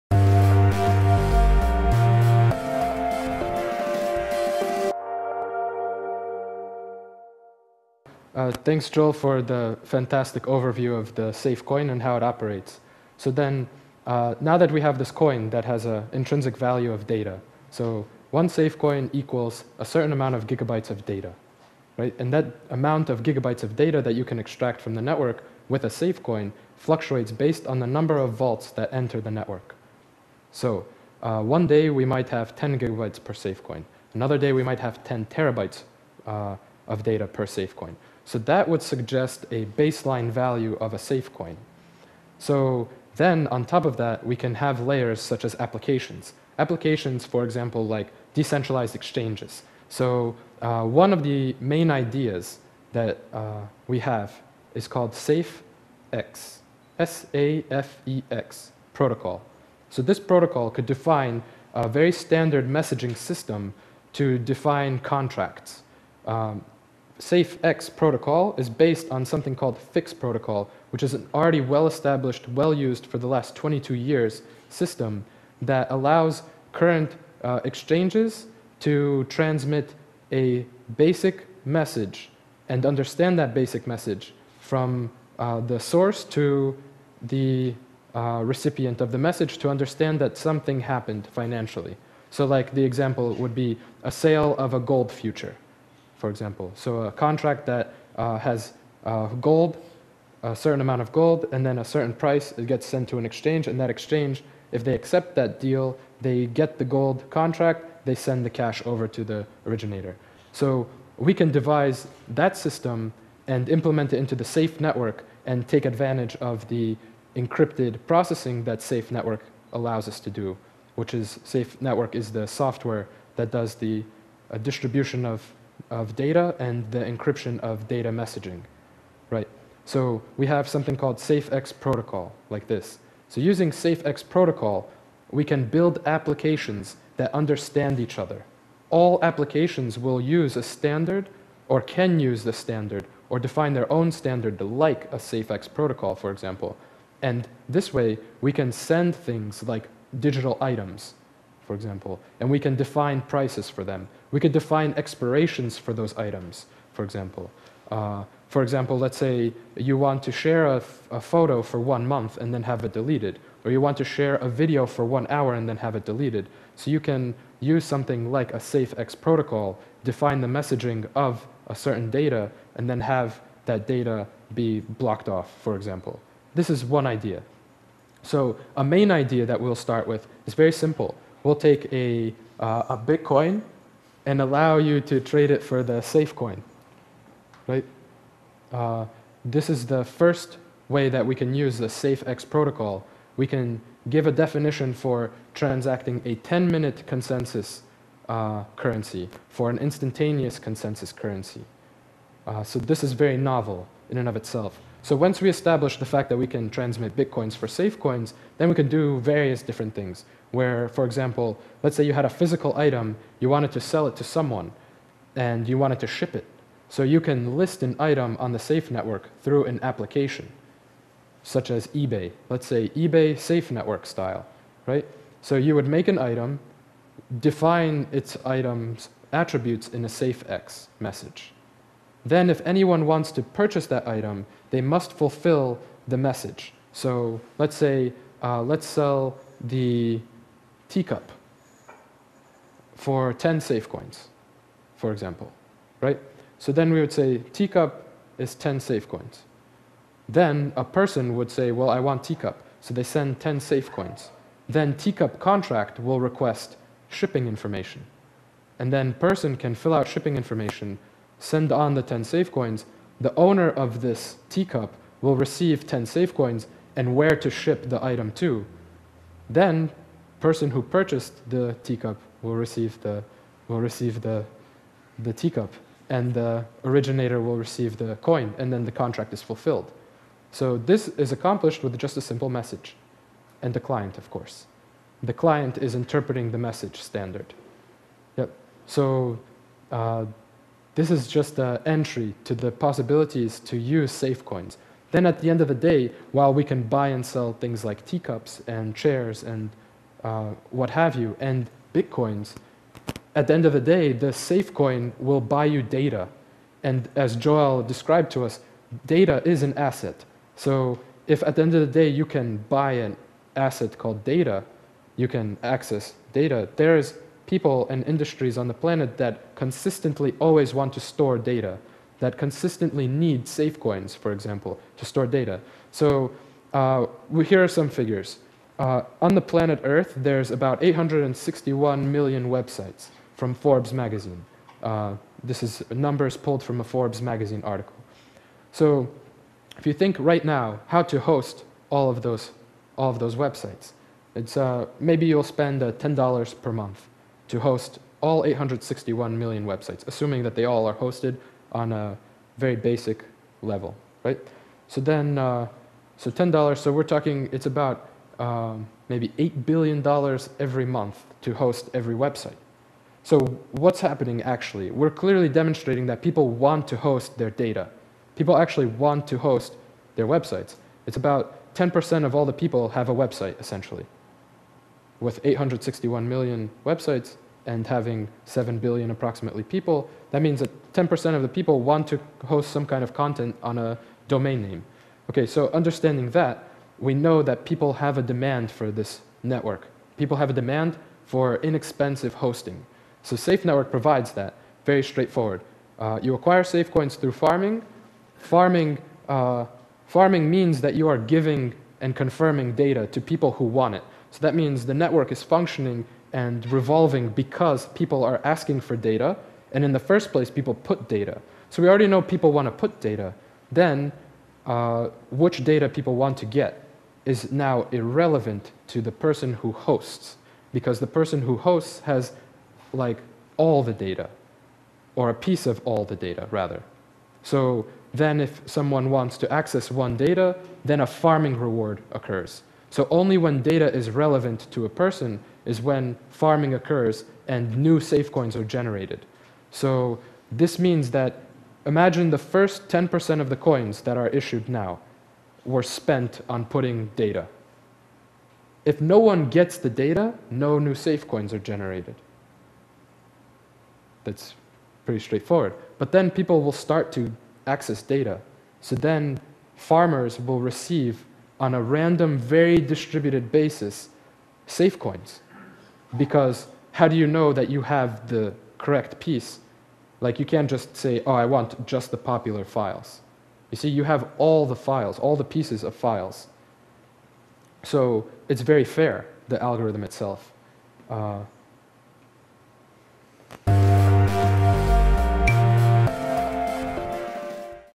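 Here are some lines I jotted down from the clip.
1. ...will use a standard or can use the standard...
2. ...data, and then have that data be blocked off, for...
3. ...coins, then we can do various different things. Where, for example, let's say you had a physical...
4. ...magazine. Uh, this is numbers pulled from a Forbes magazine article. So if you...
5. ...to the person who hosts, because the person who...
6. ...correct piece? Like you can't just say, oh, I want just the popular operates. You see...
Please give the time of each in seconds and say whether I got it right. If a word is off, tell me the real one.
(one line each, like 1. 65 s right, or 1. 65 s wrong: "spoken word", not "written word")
1. 139 s right
2. 172 s right
3. 207 s right
4. 333 s right
5. 418 s right
6. 468 s wrong: "files", not "operates".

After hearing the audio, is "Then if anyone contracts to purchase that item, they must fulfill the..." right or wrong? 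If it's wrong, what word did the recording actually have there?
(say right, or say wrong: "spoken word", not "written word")
wrong: "wants", not "contracts".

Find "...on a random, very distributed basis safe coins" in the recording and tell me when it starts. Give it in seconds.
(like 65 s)
461 s.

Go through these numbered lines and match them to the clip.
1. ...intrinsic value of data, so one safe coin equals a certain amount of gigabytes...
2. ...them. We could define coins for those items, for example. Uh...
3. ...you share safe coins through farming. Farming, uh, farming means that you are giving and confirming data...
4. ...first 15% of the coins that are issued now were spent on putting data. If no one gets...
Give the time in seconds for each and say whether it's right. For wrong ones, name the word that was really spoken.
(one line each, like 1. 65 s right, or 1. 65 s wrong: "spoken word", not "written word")
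1. 16 s right
2. 153 s wrong: "expirations", not "coins"
3. 396 s wrong: "acquire", not "share"
4. 442 s wrong: "10", not "15".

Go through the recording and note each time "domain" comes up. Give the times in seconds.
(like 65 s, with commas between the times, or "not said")
384 s.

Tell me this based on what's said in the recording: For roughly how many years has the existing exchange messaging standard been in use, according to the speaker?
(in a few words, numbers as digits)
22.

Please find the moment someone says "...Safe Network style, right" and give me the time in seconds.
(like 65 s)
223 s.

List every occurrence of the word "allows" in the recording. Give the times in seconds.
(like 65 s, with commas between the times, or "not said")
75 s, 119 s, 184 s.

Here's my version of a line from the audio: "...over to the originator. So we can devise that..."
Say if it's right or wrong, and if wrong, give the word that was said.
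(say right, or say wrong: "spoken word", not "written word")
right.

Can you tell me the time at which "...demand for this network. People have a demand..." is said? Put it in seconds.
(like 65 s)
388 s.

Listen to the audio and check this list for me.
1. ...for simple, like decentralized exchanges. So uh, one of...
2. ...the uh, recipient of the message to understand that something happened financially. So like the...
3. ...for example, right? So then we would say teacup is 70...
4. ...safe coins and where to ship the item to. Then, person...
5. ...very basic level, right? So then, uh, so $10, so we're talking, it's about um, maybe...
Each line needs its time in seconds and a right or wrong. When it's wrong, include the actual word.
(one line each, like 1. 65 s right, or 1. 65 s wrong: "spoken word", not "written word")
1. 47 s wrong: "example", not "simple"
2. 87 s right
3. 244 s wrong: "10", not "70"
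4. 266 s right
5. 352 s right.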